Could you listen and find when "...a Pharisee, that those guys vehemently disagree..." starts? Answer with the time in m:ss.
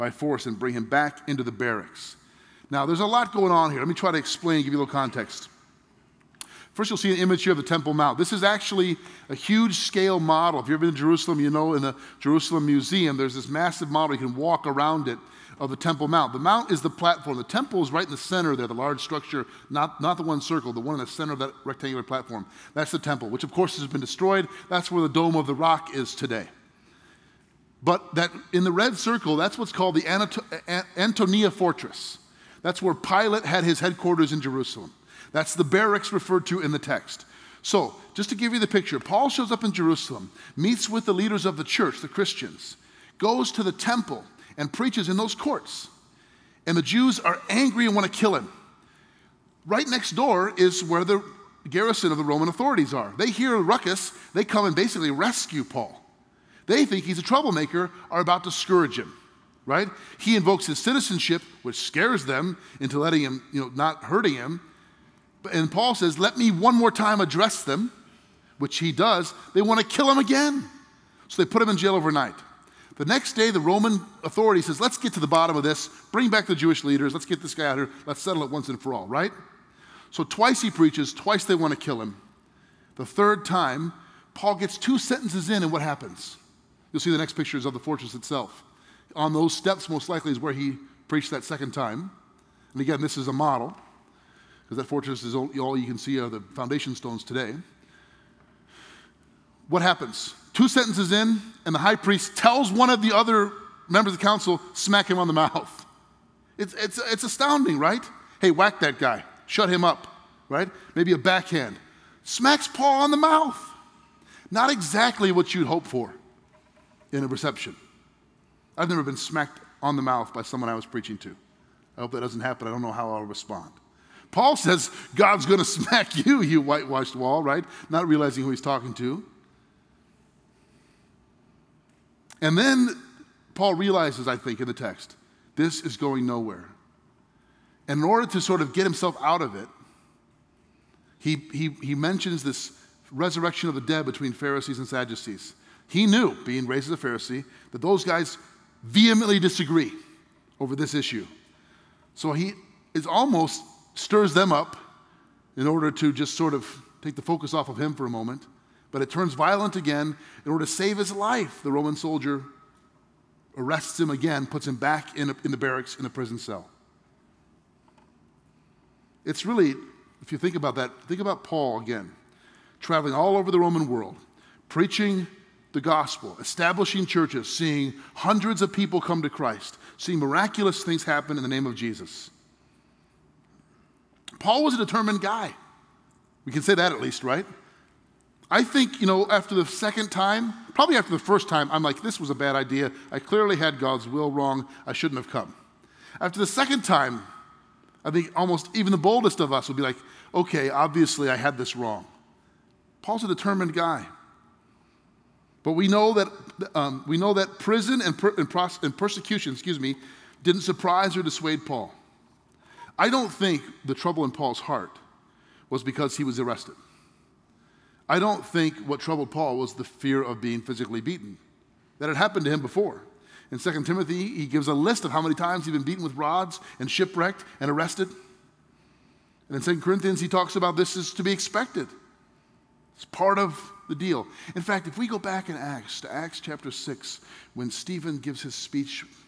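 2:26.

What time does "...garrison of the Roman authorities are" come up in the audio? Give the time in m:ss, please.
0:51.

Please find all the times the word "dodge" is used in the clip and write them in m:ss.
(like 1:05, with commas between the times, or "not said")
not said.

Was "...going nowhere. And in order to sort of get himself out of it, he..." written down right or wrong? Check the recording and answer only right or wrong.
right.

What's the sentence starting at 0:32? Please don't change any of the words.
That's where Pilate had his headquarters in Jerusalem.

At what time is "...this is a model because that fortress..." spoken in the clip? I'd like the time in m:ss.
1:33.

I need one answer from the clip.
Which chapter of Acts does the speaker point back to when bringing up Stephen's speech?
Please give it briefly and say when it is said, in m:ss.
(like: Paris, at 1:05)
6, at 3:56.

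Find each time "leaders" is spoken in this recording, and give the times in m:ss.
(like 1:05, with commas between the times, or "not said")
0:41, 1:16.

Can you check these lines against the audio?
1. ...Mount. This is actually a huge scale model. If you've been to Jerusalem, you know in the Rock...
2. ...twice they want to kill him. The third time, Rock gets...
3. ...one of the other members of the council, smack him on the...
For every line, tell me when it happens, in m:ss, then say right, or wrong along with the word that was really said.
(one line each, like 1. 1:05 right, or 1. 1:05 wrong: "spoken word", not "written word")
1. 0:07 wrong: "Jerusalem", not "Rock"
2. 1:21 wrong: "Paul", not "Rock"
3. 1:42 right.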